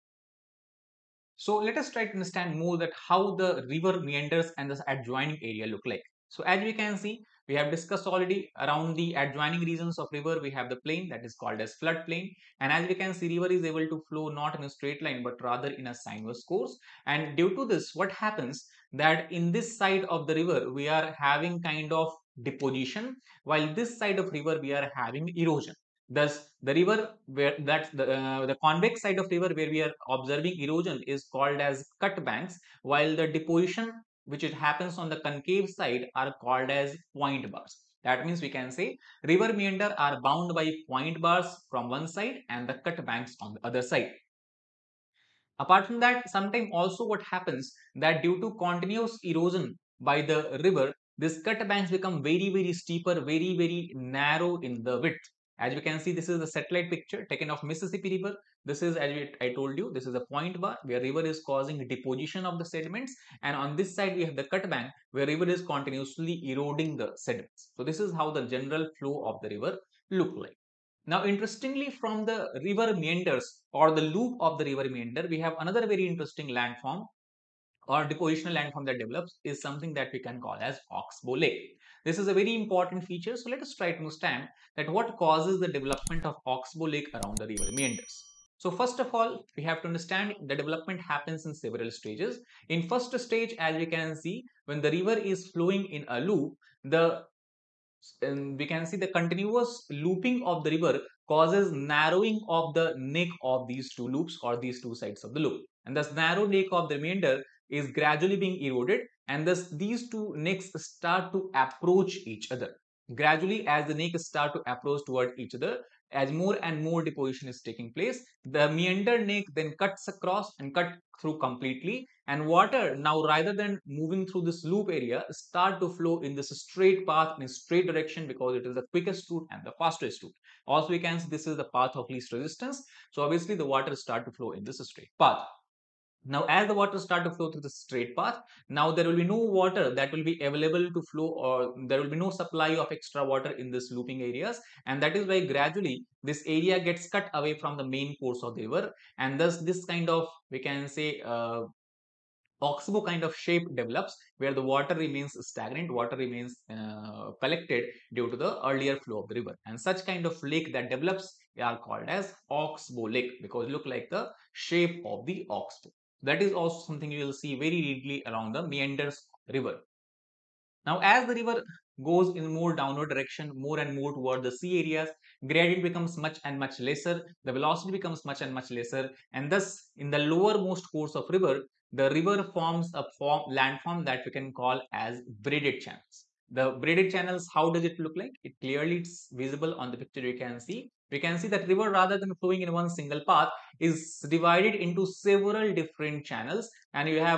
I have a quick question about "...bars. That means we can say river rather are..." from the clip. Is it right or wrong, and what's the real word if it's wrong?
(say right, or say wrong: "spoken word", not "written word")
wrong: "meander", not "rather".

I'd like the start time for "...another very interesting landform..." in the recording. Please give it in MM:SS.
01:15.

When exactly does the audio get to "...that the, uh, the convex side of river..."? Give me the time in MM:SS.
00:27.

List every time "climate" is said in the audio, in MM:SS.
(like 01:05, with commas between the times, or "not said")
not said.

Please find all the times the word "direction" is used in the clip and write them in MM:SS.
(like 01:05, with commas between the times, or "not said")
02:07, 02:53.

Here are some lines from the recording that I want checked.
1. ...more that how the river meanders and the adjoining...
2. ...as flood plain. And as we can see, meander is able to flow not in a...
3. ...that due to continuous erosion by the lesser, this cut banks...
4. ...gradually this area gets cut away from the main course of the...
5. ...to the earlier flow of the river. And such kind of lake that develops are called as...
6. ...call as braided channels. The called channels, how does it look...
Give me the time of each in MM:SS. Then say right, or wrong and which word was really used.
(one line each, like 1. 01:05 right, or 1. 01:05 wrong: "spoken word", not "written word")
1. 00:02 right
2. 00:11 wrong: "river", not "meander"
3. 00:47 wrong: "river", not "lesser"
4. 02:25 right
5. 02:38 right
6. 03:04 wrong: "braided", not "called".